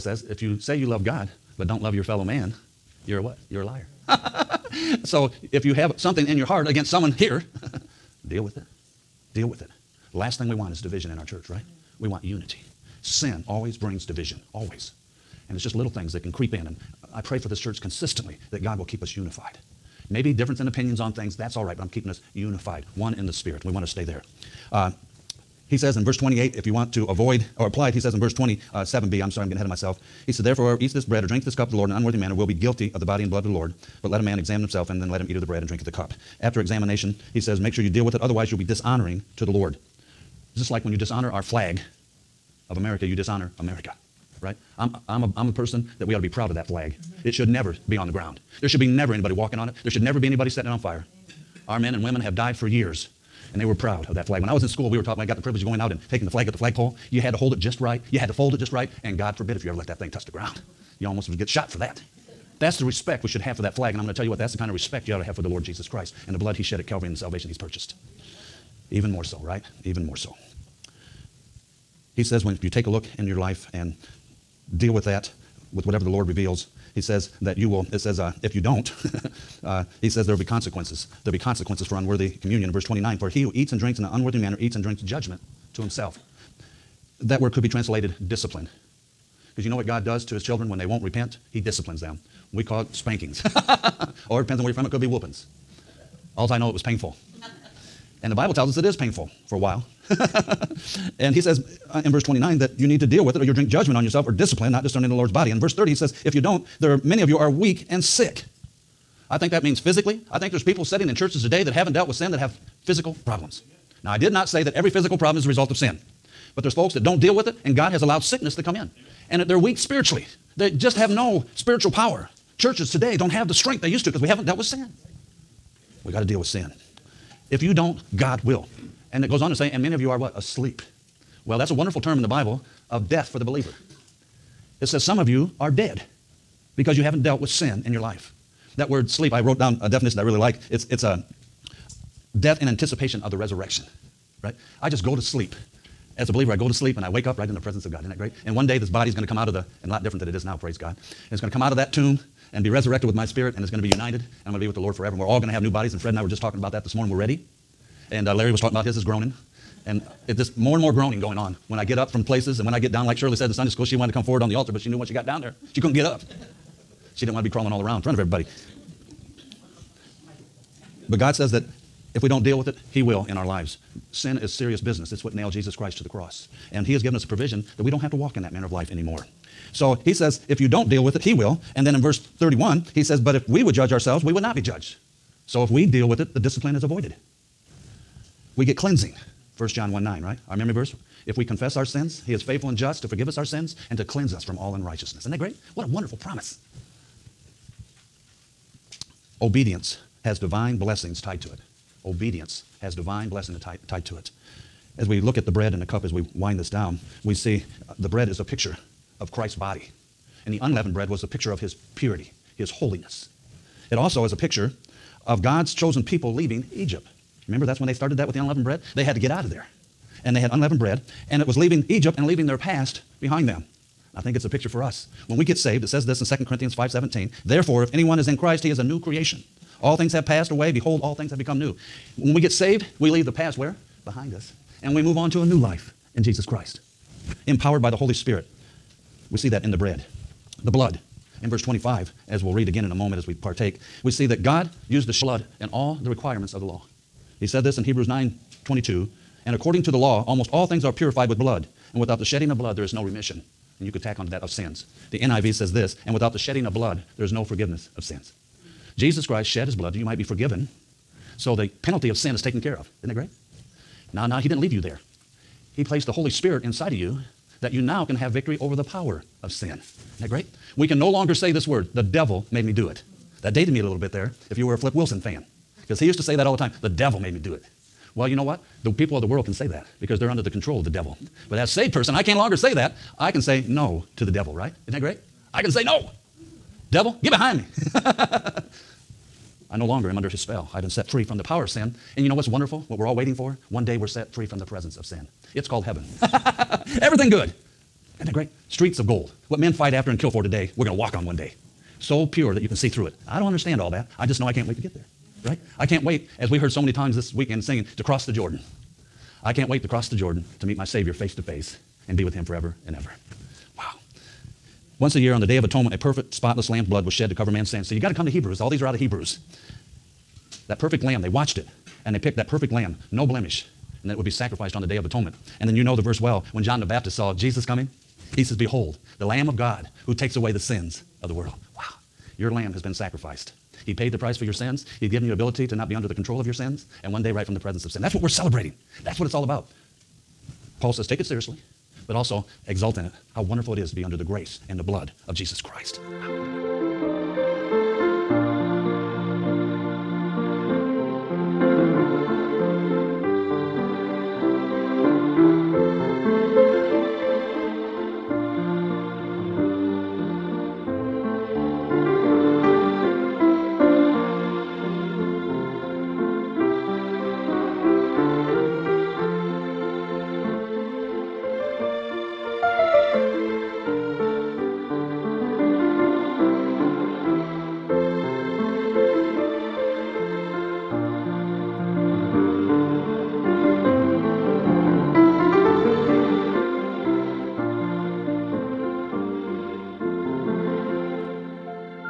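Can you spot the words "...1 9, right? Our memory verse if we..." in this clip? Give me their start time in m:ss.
3:09.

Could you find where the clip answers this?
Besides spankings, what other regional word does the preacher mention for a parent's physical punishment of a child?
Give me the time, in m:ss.
1:35.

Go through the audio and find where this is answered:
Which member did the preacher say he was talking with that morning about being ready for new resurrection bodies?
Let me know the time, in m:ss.
2:35.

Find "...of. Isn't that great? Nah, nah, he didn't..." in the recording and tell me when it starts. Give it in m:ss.
4:22.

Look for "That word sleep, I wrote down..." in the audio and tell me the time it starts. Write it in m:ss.
2:18.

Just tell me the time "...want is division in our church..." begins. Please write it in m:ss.
0:10.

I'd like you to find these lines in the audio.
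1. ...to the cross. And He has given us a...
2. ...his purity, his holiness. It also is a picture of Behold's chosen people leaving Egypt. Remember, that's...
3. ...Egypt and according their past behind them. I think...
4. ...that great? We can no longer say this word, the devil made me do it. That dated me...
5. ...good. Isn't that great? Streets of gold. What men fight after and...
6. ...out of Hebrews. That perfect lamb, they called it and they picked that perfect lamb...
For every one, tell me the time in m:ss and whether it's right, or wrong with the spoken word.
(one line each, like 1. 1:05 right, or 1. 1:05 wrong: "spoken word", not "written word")
1. 2:55 right
2. 3:31 wrong: "God", not "Behold"
3. 3:41 wrong: "leaving", not "according"
4. 4:30 right
5. 4:57 right
6. 5:18 wrong: "watched", not "called".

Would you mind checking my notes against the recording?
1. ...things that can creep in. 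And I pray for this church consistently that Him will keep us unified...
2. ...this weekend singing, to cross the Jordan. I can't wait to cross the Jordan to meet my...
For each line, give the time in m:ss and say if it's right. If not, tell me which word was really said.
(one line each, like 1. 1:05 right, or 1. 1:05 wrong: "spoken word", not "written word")
1. 0:15 wrong: "God", not "Him"
2. 5:07 right.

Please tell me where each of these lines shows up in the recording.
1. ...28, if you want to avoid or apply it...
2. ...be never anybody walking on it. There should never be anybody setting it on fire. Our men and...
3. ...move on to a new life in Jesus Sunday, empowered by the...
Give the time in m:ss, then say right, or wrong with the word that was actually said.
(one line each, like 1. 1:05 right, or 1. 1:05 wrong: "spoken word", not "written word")
1. 0:26 right
2. 0:48 right
3. 3:55 wrong: "Christ", not "Sunday".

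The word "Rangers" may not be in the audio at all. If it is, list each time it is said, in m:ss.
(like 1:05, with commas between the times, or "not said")
not said.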